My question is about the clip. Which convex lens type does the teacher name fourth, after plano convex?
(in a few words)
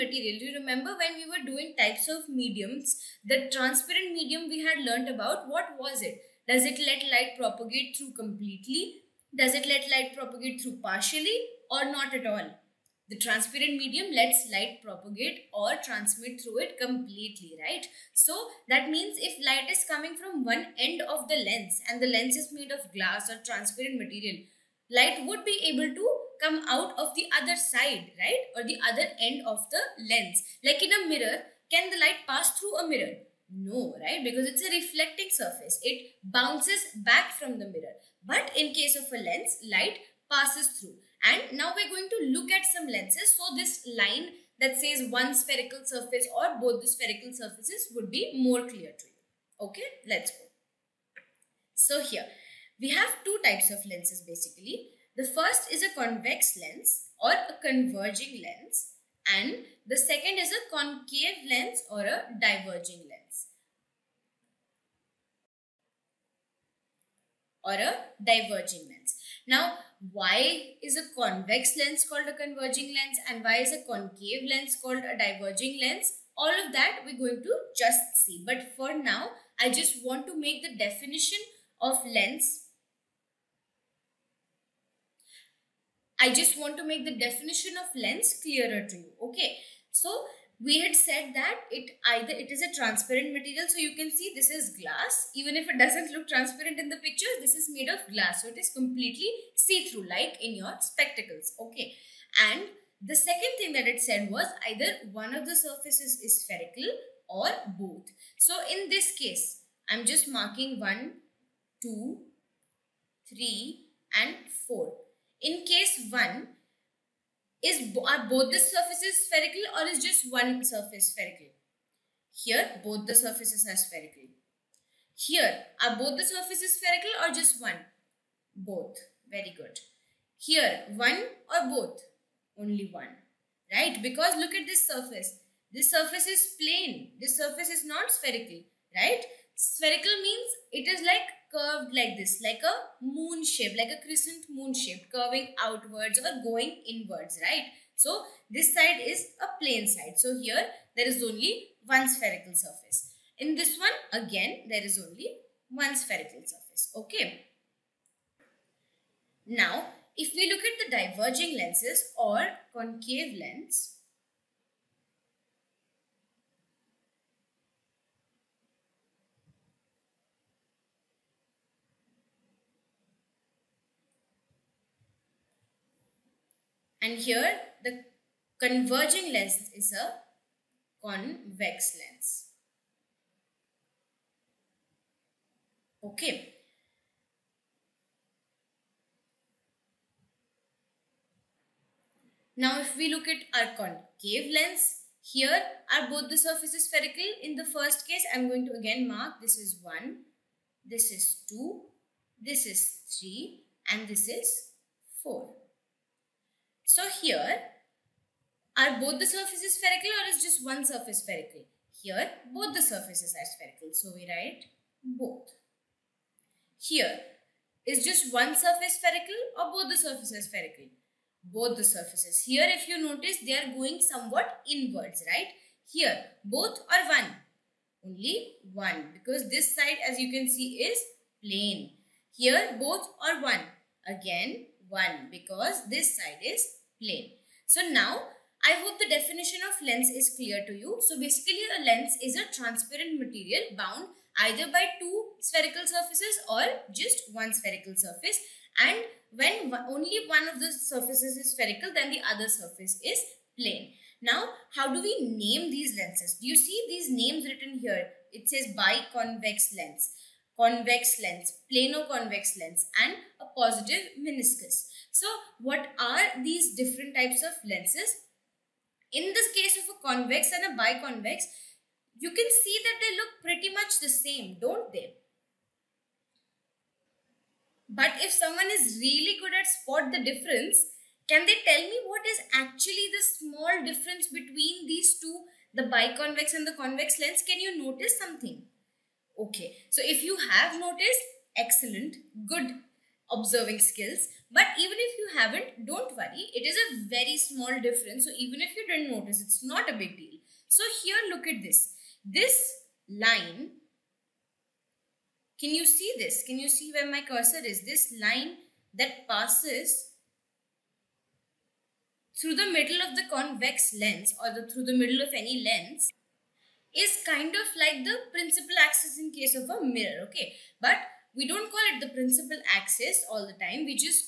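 positive meniscus.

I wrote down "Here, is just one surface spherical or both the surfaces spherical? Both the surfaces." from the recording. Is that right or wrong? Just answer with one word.
right.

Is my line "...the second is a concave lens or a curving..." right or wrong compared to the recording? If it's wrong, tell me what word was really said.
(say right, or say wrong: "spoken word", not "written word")
wrong: "diverging", not "curving".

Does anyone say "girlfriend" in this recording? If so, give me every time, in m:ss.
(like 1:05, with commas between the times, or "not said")
not said.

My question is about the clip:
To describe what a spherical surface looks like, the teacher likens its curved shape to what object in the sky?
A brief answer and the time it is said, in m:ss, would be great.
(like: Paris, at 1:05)
crescent moon, at 2:24.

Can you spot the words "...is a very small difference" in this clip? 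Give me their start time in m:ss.
4:56.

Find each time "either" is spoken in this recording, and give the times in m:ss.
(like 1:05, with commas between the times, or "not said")
1:32, 1:44, 4:04.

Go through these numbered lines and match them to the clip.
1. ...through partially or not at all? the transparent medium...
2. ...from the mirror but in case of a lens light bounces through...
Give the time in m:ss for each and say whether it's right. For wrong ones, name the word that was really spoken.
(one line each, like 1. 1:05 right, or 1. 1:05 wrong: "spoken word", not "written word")
1. 0:10 right
2. 0:37 wrong: "passes", not "bounces".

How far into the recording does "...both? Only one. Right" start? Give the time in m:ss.
2:11.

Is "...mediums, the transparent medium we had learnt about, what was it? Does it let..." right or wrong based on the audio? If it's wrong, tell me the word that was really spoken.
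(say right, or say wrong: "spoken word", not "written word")
right.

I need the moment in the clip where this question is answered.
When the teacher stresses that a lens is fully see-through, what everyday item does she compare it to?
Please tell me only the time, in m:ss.
1:40.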